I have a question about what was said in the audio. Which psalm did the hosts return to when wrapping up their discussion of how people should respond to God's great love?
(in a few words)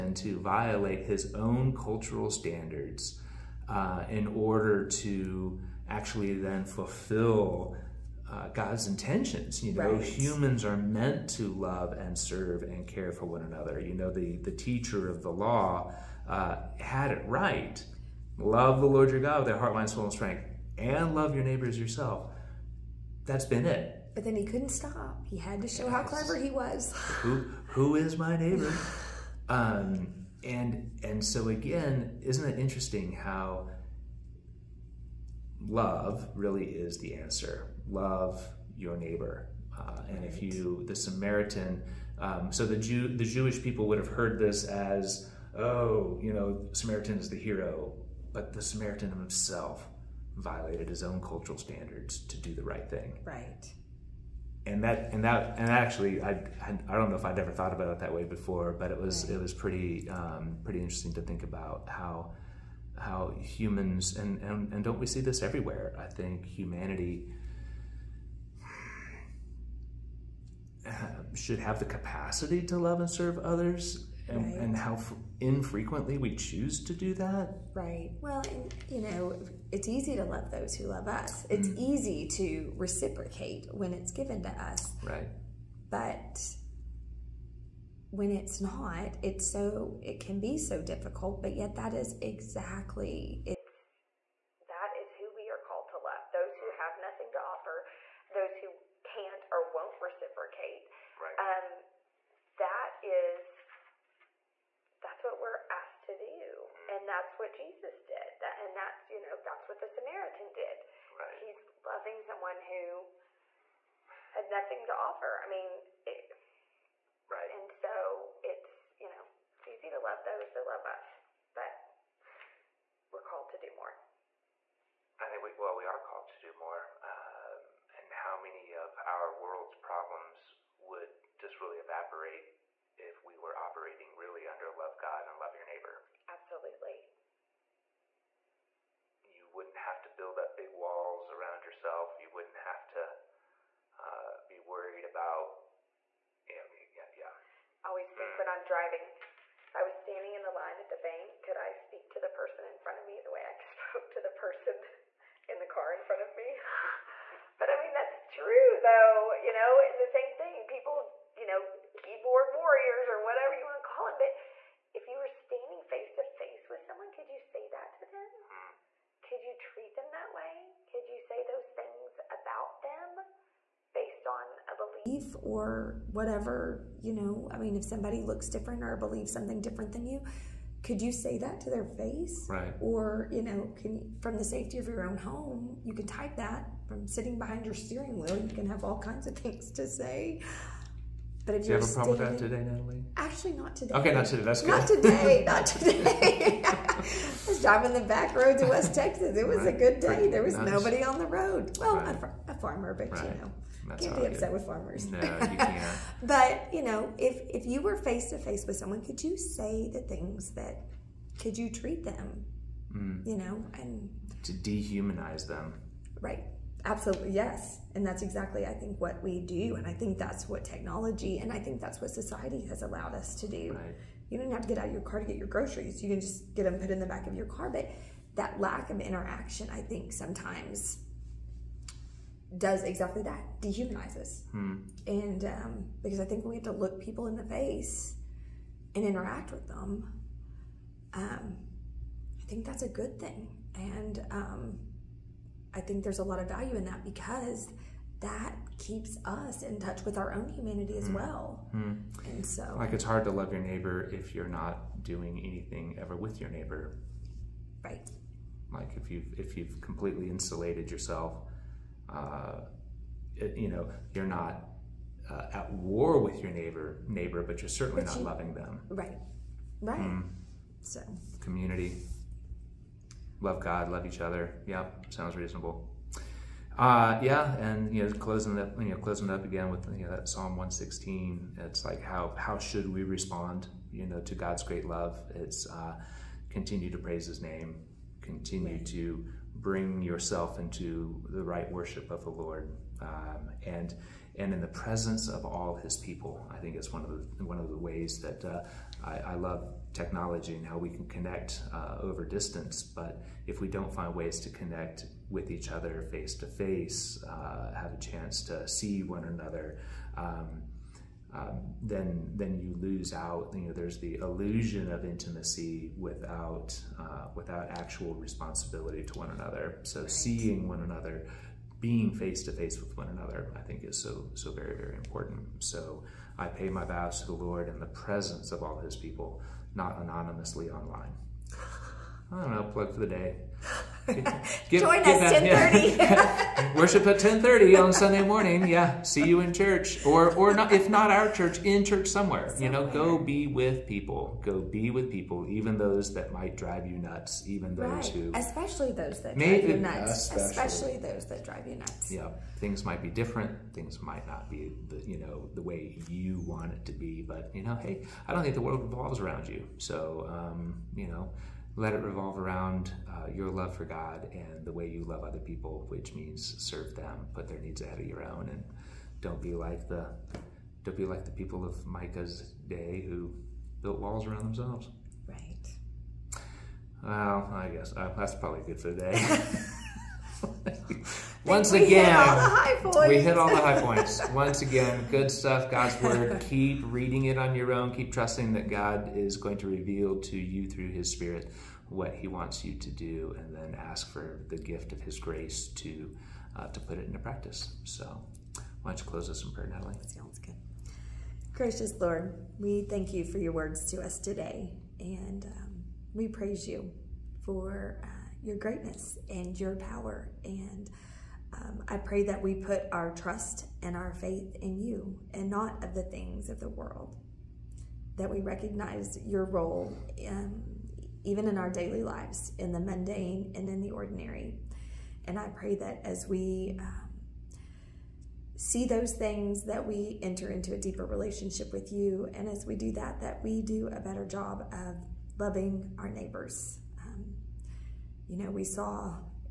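Psalm 116.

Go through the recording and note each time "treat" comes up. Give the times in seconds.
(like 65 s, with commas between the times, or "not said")
169 s, 211 s.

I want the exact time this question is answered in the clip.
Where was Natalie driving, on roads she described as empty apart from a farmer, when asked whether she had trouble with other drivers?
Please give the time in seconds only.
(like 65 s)
198 s.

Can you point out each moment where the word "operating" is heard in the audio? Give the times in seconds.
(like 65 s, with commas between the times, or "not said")
133 s.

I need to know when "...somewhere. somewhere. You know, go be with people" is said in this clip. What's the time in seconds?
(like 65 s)
342 s.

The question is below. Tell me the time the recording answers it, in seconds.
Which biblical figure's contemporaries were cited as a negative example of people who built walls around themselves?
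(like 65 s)
371 s.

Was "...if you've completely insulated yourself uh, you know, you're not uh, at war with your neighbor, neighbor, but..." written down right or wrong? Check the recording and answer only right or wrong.
right.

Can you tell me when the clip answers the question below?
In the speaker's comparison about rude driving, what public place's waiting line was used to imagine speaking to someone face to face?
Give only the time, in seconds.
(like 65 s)
150 s.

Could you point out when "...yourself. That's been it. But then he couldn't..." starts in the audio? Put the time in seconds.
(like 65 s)
21 s.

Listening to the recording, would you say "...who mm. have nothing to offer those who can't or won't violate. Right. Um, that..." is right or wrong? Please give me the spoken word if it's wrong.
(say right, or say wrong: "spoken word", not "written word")
wrong: "reciprocate", not "violate".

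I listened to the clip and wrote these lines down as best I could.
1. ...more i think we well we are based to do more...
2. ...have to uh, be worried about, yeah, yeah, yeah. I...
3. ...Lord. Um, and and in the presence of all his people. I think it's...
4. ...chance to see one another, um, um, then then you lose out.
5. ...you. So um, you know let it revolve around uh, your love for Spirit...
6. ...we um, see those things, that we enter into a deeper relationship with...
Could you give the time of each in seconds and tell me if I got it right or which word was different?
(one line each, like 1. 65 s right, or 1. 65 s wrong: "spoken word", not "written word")
1. 123 s wrong: "called", not "based"
2. 142 s right
3. 292 s right
4. 307 s right
5. 359 s wrong: "God", not "Spirit"
6. 426 s right.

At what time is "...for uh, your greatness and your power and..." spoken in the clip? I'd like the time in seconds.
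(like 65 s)
407 s.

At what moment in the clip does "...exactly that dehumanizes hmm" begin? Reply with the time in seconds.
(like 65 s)
232 s.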